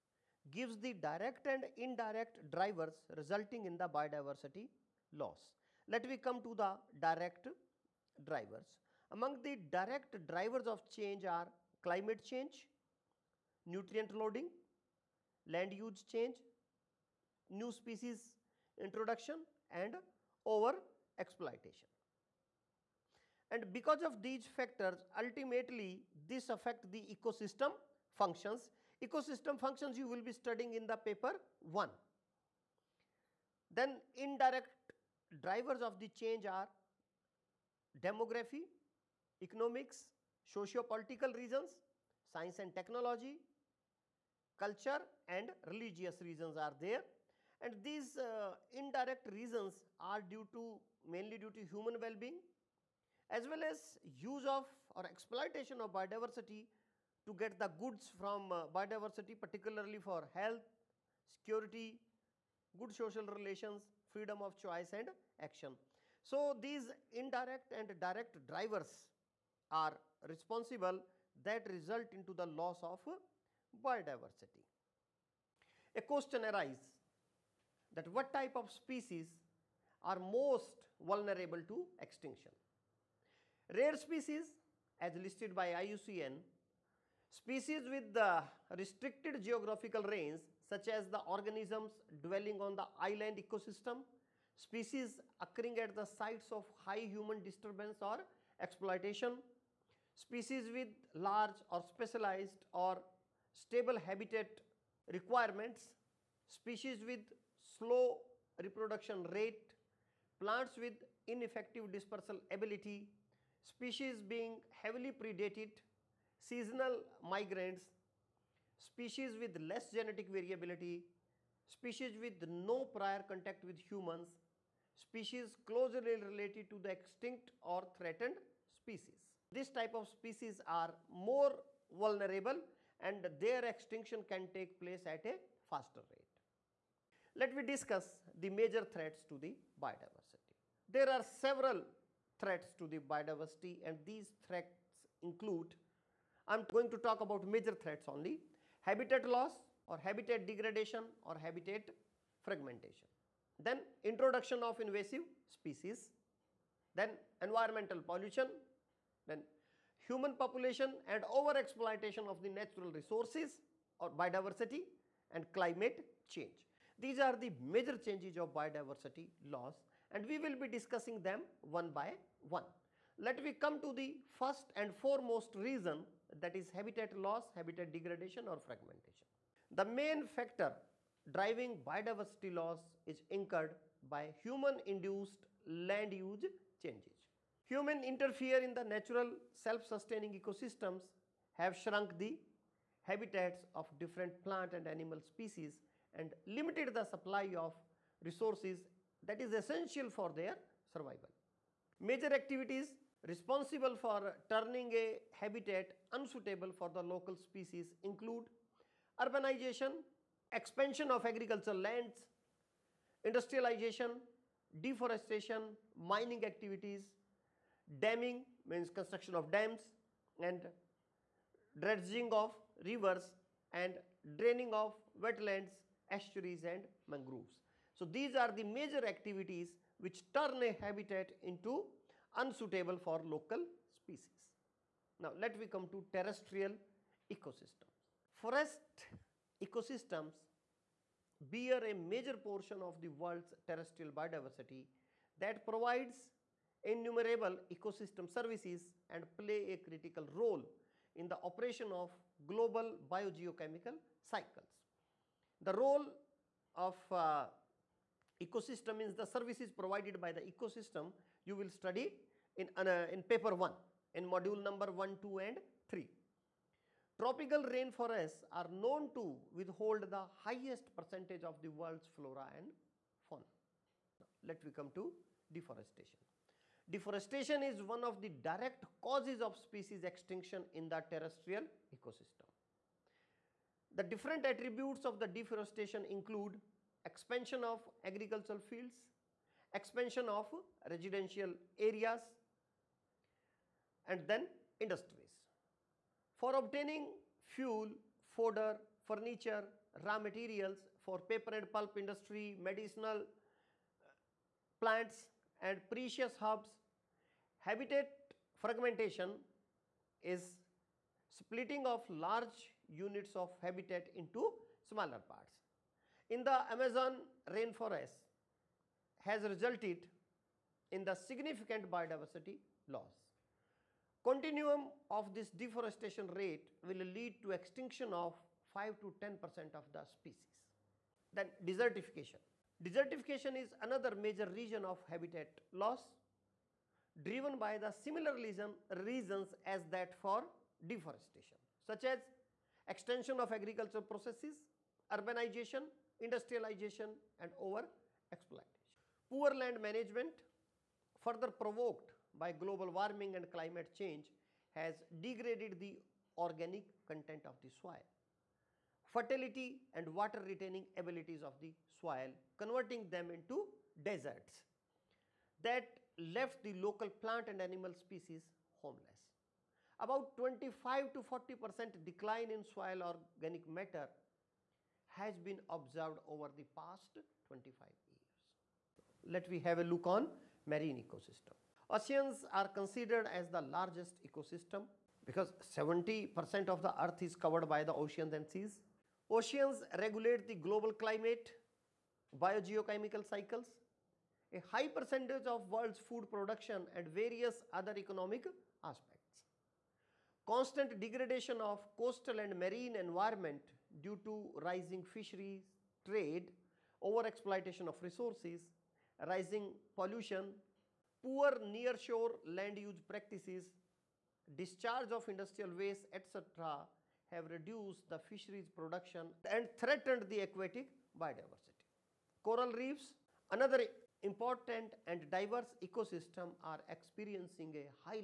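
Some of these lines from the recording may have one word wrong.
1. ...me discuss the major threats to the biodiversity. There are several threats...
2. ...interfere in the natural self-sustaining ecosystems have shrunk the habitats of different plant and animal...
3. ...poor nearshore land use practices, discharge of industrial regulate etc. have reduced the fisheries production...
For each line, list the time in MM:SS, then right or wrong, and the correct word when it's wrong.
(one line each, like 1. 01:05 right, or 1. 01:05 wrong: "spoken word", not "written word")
1. 02:17 right
2. 03:08 right
3. 06:51 wrong: "waste", not "regulate".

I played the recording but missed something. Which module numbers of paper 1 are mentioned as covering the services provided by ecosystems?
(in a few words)
1, 2 and 3.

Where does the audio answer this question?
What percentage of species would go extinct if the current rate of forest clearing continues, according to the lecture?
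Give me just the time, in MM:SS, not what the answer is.
05:28.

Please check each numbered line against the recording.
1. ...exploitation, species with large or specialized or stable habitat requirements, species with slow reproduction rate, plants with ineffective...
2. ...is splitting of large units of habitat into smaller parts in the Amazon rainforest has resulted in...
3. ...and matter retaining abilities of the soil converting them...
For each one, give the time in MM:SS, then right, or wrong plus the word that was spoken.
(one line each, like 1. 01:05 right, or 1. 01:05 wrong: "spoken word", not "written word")
1. 01:38 right
2. 05:10 right
3. 05:59 wrong: "water", not "matter".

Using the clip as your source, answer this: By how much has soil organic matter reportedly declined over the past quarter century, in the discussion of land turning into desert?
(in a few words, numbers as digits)
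25 to 40 percent.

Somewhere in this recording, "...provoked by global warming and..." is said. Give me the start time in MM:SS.
05:51.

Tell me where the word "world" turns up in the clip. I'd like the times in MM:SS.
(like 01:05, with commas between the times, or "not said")
04:03, 04:31, 06:35.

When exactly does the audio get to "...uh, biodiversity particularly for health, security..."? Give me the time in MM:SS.
00:58.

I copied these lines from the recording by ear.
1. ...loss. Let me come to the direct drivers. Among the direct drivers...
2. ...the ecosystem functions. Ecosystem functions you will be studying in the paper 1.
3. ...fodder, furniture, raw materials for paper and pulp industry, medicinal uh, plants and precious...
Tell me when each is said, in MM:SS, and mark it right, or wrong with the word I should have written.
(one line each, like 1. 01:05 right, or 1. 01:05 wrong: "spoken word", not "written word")
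1. 00:05 right
2. 00:26 right
3. 04:58 right.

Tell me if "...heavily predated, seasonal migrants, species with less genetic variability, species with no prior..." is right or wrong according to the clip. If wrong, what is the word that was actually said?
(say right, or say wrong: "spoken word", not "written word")
right.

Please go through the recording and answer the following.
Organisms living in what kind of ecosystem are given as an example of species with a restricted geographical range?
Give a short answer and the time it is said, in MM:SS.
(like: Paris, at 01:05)
island ecosystem, at 01:33.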